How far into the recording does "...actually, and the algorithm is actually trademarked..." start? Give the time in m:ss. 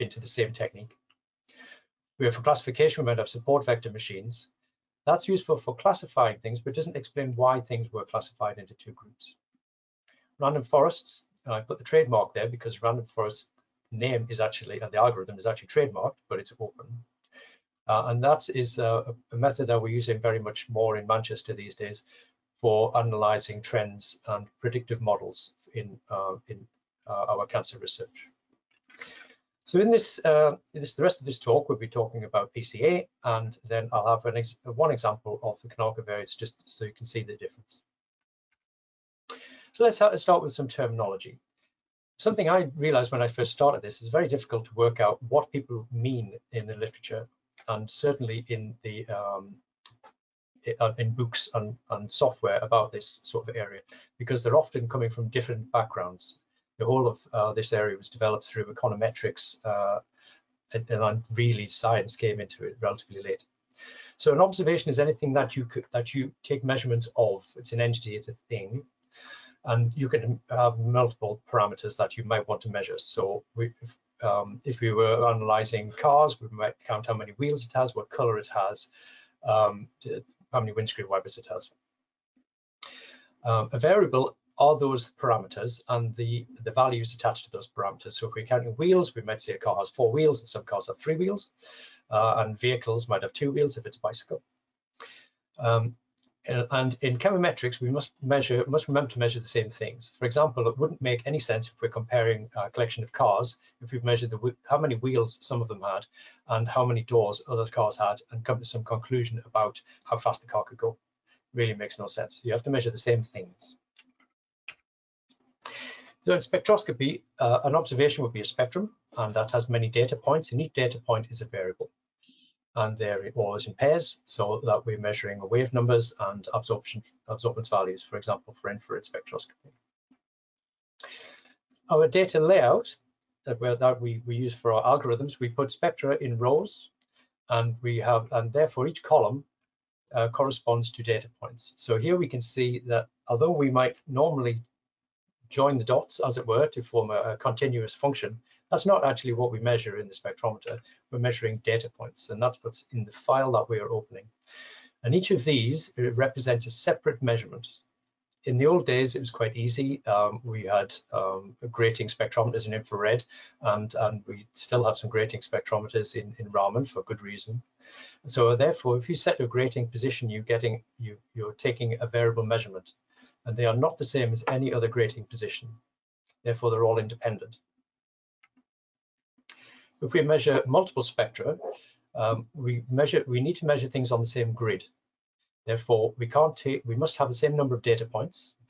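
0:14.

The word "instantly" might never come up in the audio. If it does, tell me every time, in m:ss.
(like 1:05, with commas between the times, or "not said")
not said.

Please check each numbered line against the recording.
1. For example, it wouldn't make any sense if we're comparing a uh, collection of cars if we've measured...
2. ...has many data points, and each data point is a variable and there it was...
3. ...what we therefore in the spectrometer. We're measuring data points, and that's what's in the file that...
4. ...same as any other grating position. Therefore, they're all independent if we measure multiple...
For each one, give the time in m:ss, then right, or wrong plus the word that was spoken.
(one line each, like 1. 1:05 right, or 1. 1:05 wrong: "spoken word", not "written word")
1. 1:40 right
2. 1:59 right
3. 2:29 wrong: "measure", not "therefore"
4. 2:54 right.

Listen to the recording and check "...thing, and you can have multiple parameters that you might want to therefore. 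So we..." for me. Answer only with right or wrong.
wrong.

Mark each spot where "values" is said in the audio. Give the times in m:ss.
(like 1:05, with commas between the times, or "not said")
1:26, 2:07.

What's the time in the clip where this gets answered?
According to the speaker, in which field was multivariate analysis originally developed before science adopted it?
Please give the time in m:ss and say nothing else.
0:58.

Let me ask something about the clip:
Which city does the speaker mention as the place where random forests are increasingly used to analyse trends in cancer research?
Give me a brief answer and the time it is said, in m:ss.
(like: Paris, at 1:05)
Manchester, at 0:21.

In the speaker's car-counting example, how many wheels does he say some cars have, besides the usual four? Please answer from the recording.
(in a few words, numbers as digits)
3.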